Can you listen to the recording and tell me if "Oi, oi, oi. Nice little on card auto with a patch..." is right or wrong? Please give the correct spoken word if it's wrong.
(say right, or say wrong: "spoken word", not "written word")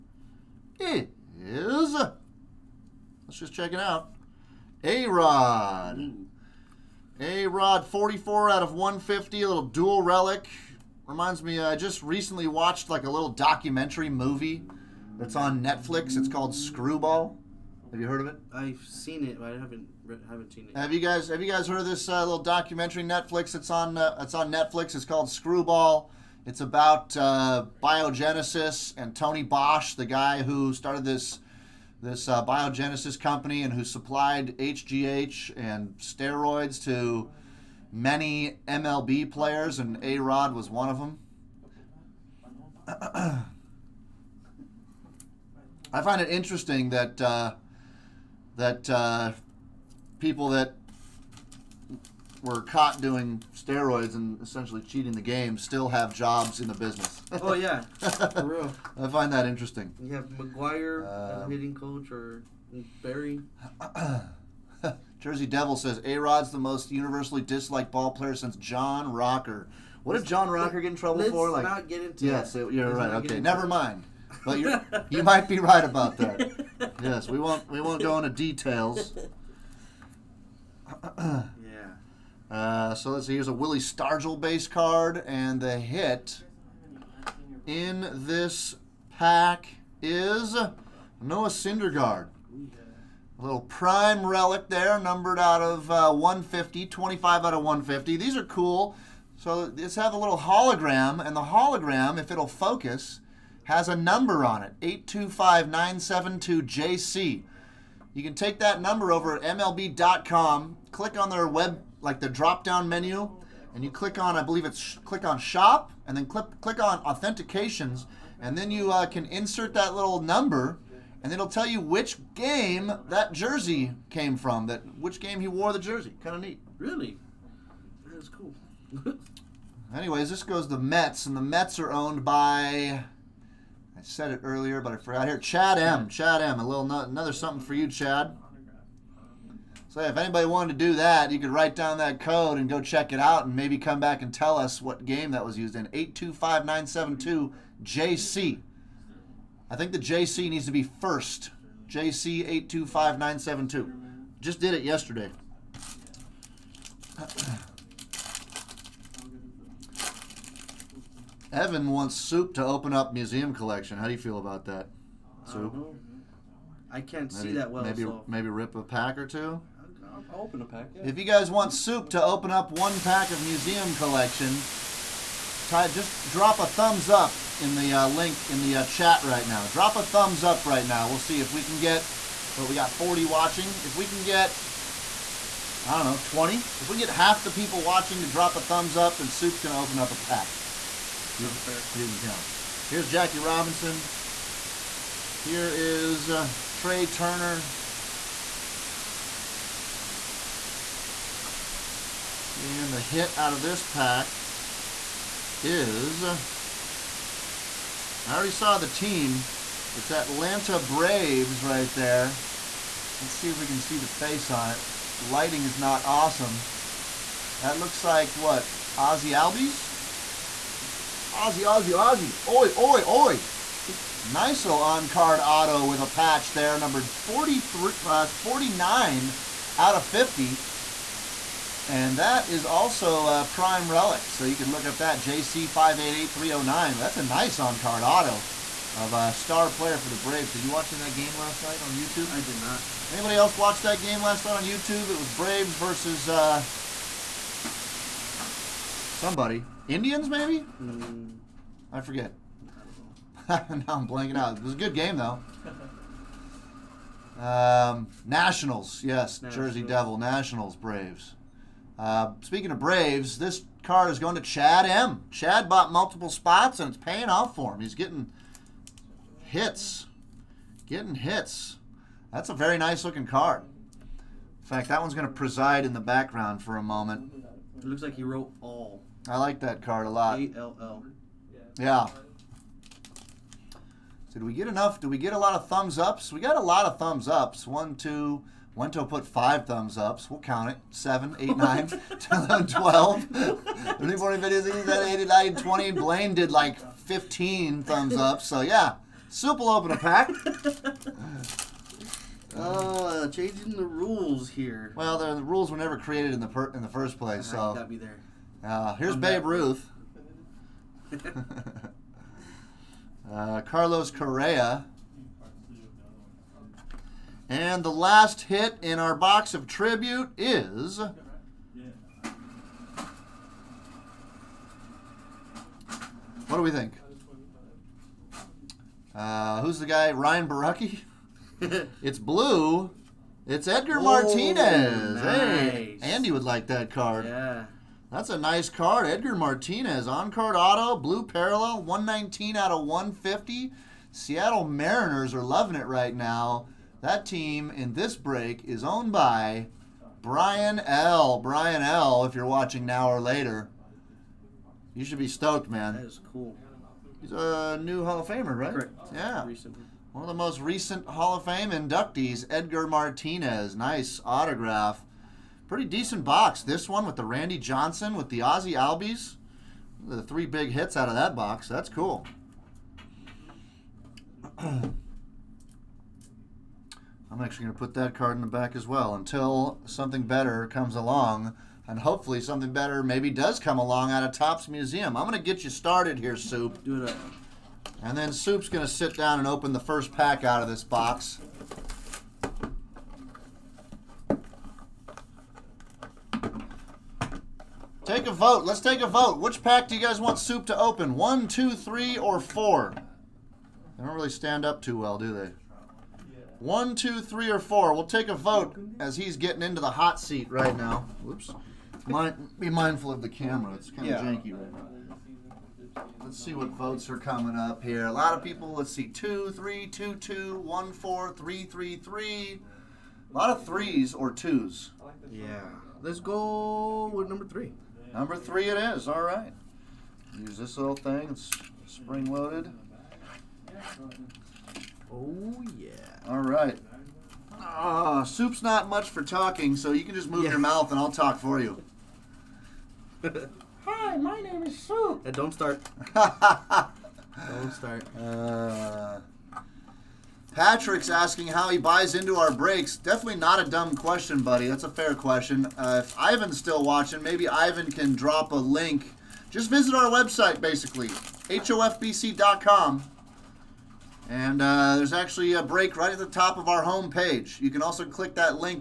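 right.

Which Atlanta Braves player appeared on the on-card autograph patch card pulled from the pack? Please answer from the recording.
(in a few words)
Ozzie Albies.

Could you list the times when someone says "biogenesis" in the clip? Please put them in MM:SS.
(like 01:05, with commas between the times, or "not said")
00:27, 00:32.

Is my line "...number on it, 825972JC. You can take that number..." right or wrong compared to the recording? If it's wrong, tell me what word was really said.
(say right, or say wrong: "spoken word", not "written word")
right.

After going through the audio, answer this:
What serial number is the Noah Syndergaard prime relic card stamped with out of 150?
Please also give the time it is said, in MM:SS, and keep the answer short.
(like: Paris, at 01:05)
25, at 01:36.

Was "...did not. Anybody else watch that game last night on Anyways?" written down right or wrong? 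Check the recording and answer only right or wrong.
wrong.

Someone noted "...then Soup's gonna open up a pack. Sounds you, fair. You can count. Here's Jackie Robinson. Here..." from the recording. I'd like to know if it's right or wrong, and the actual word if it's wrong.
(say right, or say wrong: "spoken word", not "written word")
right.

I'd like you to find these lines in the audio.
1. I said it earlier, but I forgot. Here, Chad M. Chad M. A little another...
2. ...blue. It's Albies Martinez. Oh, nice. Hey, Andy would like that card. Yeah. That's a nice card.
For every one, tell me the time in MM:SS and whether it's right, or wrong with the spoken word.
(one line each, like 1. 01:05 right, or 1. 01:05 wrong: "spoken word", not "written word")
1. 02:13 right
2. 05:32 wrong: "Edgar", not "Albies".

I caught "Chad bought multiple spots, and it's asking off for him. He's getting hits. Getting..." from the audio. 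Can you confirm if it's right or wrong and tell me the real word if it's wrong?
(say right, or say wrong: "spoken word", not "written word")
wrong: "paying", not "asking".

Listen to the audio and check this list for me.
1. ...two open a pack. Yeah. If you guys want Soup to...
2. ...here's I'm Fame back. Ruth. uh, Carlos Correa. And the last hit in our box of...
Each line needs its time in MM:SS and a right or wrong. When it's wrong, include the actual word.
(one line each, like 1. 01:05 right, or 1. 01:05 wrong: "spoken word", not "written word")
1. 02:49 right
2. 05:08 wrong: "Babe", not "Fame".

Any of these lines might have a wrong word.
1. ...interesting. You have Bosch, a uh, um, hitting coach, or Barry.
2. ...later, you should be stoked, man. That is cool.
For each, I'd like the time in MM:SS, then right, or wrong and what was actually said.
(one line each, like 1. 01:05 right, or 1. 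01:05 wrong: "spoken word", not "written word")
1. 00:59 wrong: "McGwire", not "Bosch"
2. 05:53 right.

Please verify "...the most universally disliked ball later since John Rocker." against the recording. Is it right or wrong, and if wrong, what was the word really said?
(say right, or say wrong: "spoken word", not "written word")
wrong: "player", not "later".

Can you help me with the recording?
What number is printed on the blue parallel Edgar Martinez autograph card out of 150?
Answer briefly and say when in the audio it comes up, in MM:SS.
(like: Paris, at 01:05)
119, at 05:41.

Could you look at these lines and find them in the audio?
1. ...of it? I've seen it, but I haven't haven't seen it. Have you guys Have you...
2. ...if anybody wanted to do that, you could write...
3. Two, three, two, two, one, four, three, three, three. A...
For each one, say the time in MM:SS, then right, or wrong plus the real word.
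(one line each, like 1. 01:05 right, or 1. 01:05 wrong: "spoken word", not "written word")
1. 00:18 right
2. 02:20 right
3. 06:59 right.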